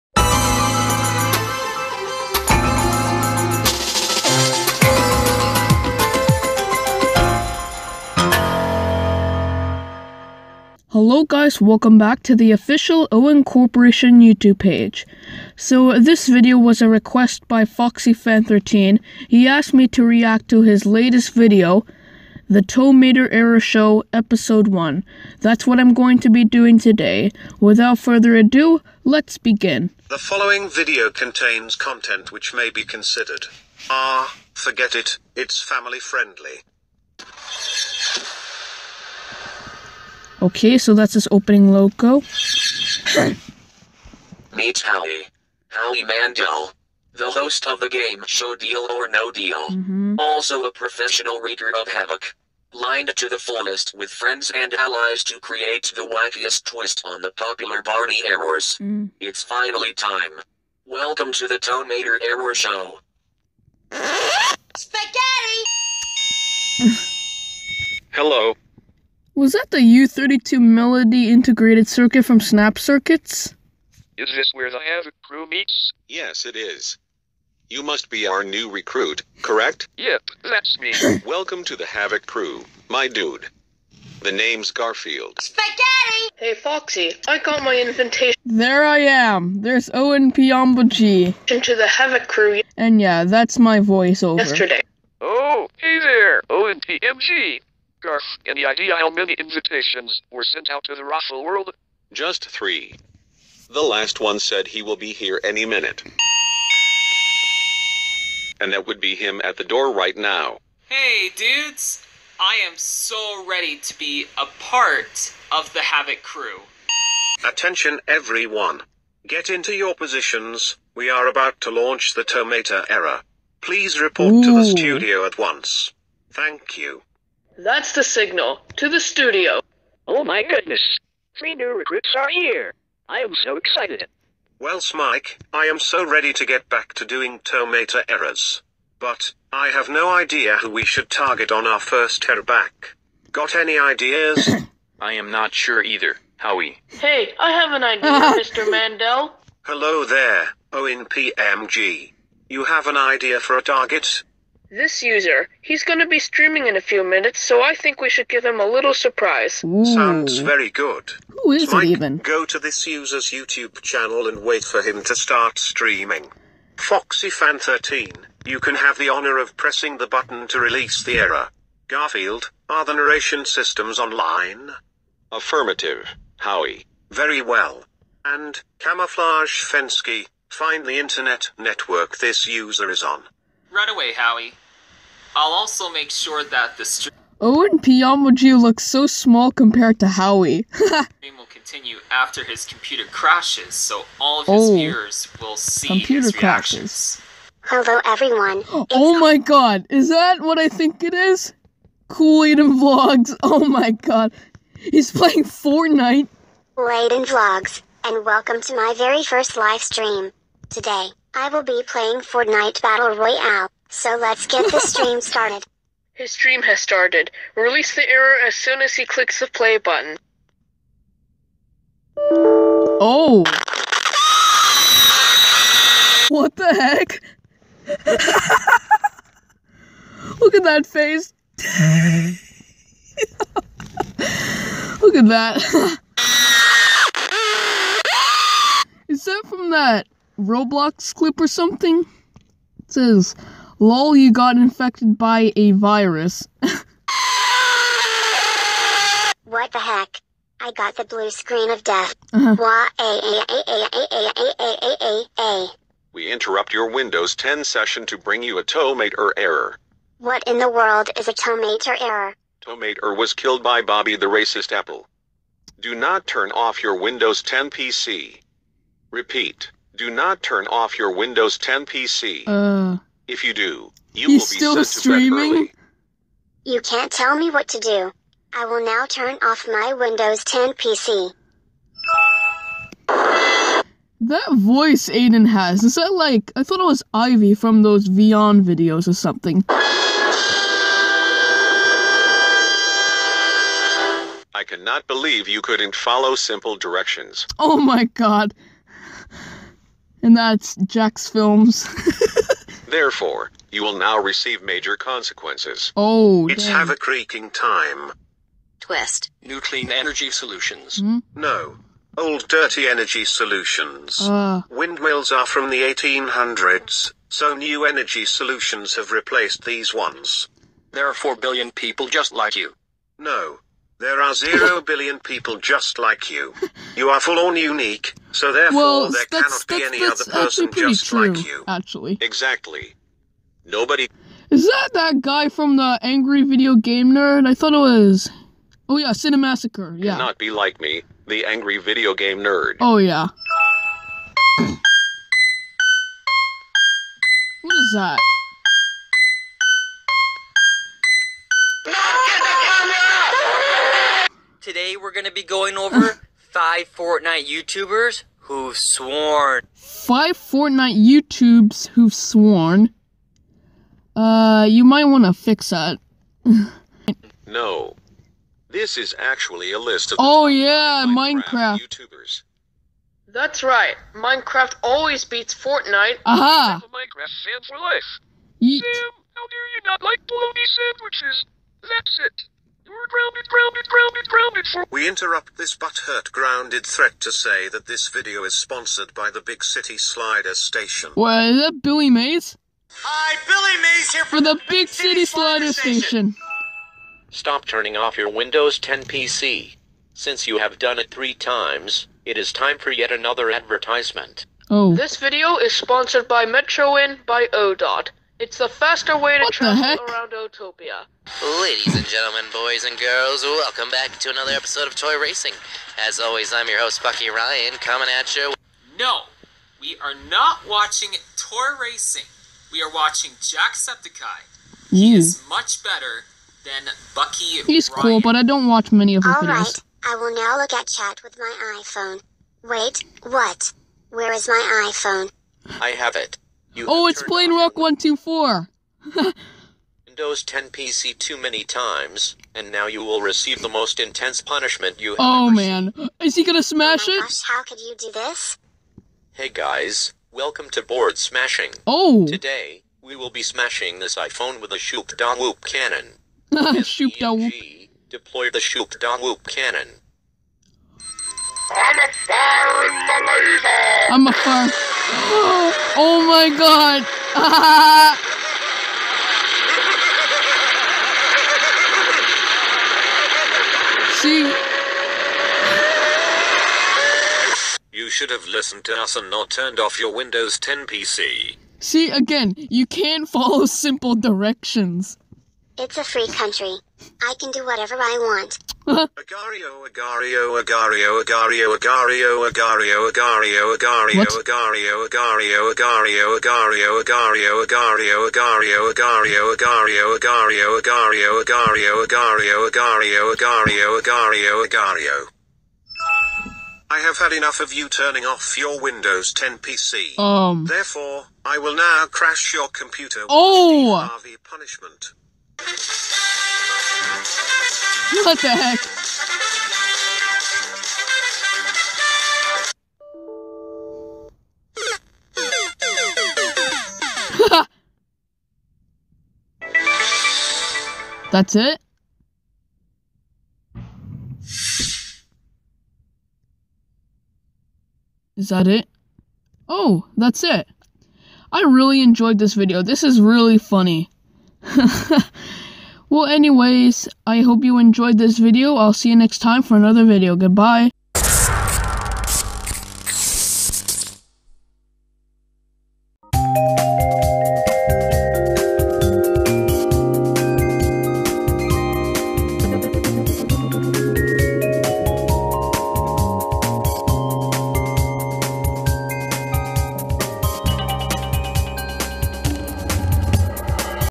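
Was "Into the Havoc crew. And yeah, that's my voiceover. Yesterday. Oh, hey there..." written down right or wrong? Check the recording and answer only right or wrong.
right.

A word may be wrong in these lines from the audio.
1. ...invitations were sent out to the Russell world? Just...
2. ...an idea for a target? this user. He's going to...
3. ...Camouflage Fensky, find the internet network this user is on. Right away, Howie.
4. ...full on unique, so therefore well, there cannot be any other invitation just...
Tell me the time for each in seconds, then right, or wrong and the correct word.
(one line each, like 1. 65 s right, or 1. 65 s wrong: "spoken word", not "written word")
1. 99 s right
2. 152 s right
3. 178 s right
4. 327 s wrong: "person", not "invitation".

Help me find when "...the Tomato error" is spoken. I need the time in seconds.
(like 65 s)
122 s.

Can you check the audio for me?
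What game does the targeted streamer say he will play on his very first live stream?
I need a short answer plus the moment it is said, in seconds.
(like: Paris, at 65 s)
Fortnite Battle Royale, at 212 s.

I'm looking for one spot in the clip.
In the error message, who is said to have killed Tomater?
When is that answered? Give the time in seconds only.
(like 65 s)
263 s.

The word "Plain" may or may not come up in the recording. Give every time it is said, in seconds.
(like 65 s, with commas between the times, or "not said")
437 s.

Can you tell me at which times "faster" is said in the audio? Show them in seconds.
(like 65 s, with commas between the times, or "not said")
408 s.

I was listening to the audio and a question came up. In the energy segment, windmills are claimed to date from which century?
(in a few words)
1800s.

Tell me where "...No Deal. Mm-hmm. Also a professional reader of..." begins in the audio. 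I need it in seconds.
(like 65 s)
49 s.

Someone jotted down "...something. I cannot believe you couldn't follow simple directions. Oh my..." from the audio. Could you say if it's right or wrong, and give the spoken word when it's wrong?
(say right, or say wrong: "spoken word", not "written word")
right.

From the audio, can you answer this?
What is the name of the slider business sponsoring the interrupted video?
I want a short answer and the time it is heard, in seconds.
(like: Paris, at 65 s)
Big City Slider Station, at 389 s.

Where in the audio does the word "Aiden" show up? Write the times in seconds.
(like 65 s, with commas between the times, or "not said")
202 s, 285 s.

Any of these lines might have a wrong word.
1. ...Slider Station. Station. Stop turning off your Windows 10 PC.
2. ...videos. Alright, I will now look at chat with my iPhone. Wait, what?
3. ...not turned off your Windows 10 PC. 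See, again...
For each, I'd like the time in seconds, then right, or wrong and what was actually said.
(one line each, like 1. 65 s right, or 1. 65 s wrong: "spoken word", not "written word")
1. 395 s right
2. 429 s right
3. 479 s right.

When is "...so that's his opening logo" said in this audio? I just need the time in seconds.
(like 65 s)
40 s.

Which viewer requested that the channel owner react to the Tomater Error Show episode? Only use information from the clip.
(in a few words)
FoxyFan13.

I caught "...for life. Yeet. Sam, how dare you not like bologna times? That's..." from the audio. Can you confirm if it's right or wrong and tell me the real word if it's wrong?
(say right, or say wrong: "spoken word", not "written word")
wrong: "sandwiches", not "times".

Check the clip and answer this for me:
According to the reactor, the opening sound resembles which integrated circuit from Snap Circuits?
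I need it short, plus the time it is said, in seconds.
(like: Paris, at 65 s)
U32 Melody, at 69 s.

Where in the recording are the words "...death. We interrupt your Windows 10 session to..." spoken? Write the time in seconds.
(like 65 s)
251 s.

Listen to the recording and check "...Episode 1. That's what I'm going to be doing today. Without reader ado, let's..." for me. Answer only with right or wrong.
wrong.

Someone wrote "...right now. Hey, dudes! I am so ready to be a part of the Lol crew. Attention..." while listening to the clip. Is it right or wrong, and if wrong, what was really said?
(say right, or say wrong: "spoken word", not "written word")
wrong: "Havoc", not "Lol".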